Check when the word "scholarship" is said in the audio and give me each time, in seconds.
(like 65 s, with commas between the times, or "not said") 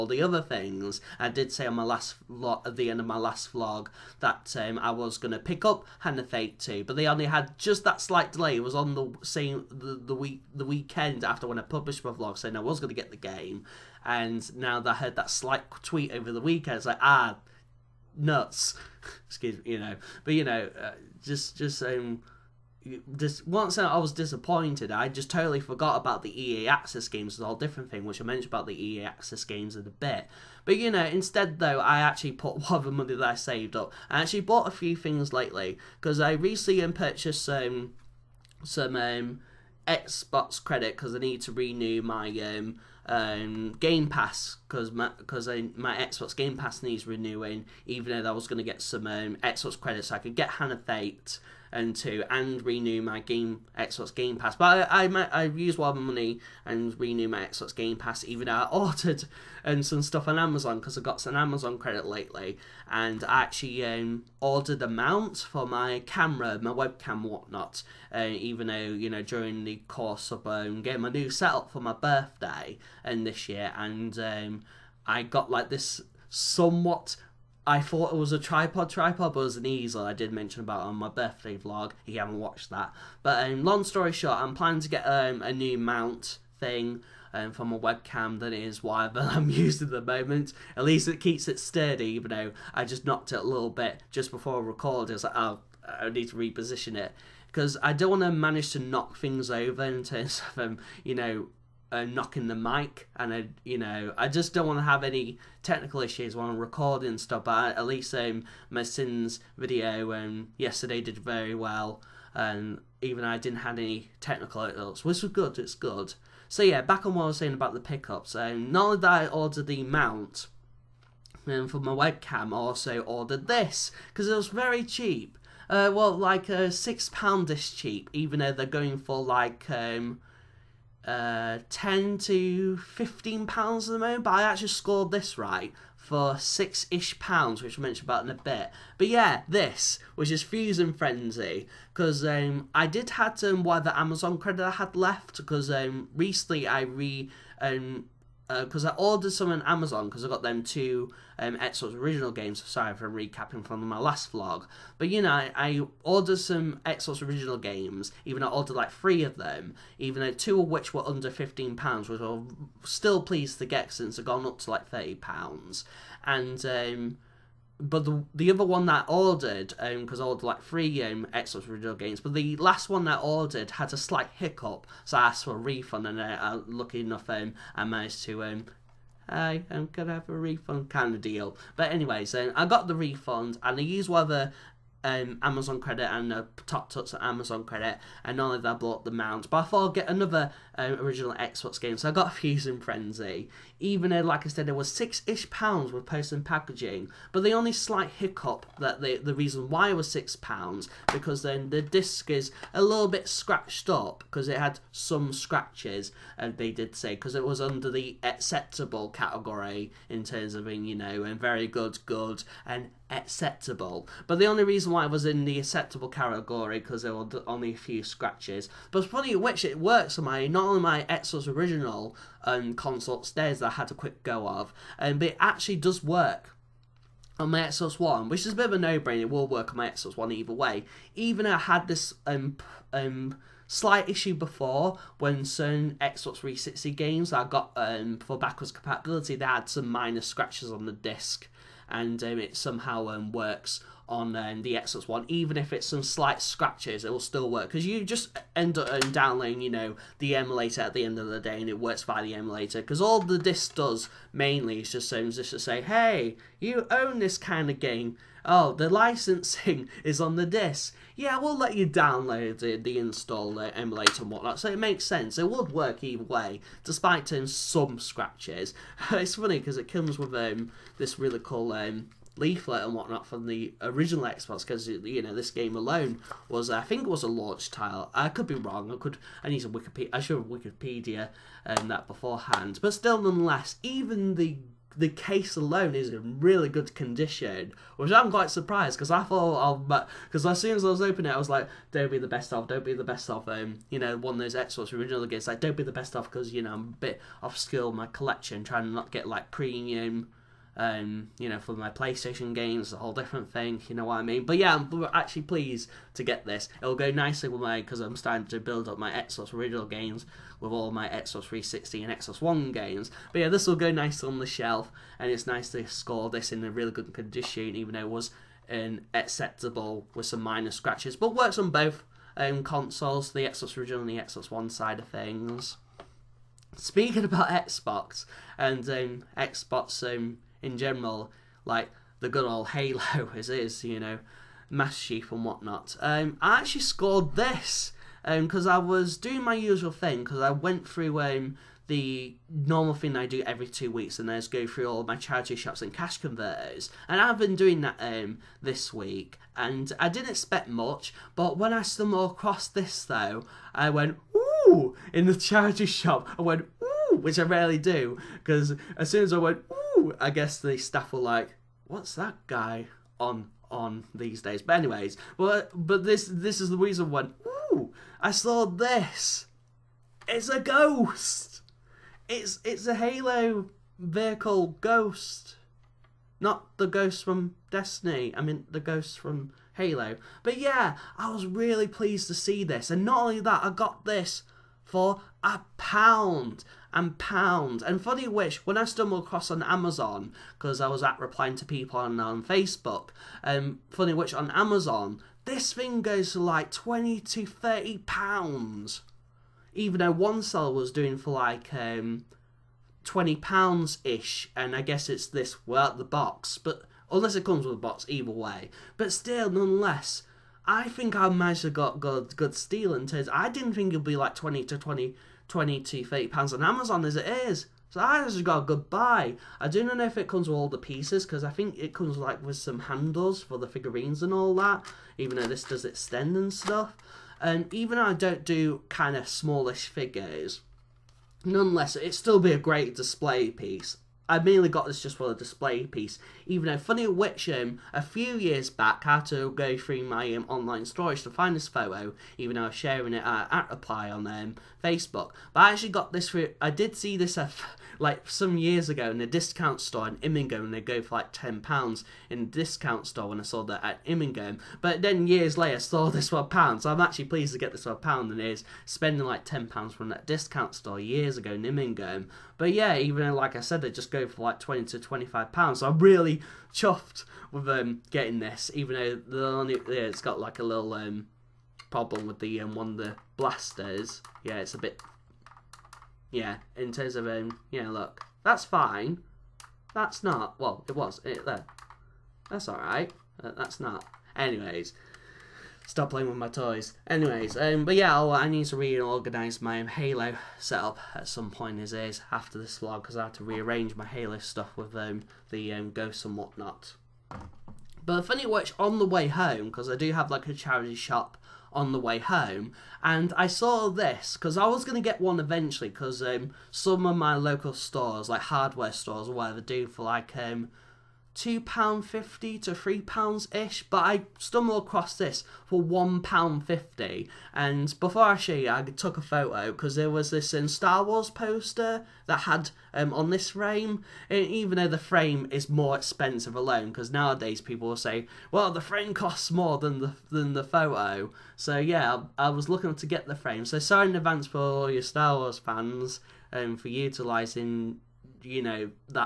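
not said.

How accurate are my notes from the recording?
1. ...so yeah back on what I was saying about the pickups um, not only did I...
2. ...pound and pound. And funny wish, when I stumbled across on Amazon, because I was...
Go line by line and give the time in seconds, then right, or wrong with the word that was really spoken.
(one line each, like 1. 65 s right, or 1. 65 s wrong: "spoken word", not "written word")
1. 116 s right
2. 385 s right.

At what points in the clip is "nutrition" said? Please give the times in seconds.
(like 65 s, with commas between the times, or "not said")
not said.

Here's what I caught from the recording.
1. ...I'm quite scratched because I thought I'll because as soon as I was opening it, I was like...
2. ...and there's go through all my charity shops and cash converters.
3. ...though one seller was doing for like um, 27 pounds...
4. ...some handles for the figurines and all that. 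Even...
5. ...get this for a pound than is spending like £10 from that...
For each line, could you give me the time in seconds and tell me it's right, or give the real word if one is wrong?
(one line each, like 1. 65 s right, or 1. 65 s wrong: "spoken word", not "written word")
1. 288 s wrong: "surprised", not "scratched"
2. 344 s right
3. 399 s wrong: "20", not "27"
4. 422 s right
5. 457 s right.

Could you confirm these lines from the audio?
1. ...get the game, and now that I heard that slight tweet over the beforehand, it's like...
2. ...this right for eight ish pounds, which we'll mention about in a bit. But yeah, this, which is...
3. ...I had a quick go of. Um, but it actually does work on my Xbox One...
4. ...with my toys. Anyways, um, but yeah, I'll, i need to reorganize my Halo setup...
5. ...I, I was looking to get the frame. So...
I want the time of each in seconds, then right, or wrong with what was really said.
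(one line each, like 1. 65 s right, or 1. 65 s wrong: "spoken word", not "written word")
1. 12 s wrong: "weekend", not "beforehand"
2. 135 s wrong: "six", not "eight"
3. 223 s right
4. 486 s right
5. 532 s right.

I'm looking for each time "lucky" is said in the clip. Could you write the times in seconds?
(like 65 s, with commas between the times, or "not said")
176 s.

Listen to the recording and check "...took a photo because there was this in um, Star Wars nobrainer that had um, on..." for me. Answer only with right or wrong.
wrong.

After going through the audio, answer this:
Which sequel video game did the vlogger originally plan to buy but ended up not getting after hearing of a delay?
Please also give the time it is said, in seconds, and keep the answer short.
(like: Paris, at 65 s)
Hand of Fate 2, at 5 s.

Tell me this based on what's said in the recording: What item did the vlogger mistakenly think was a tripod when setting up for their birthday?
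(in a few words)
An easel.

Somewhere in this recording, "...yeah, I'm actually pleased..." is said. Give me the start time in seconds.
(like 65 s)
304 s.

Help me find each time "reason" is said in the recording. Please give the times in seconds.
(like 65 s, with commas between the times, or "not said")
199 s, 214 s, 366 s.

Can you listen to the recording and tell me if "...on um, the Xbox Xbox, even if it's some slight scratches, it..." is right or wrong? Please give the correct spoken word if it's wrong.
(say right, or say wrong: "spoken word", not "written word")
wrong: "One", not "Xbox".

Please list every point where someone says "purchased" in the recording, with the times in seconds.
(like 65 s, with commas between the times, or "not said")
36 s.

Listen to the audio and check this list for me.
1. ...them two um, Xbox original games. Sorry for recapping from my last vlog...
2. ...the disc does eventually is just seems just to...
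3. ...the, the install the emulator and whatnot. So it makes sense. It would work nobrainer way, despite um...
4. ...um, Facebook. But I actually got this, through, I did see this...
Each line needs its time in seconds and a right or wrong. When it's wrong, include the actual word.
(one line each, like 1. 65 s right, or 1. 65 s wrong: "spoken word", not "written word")
1. 150 s right
2. 253 s wrong: "mainly", not "eventually"
3. 262 s wrong: "either", not "nobrainer"
4. 444 s right.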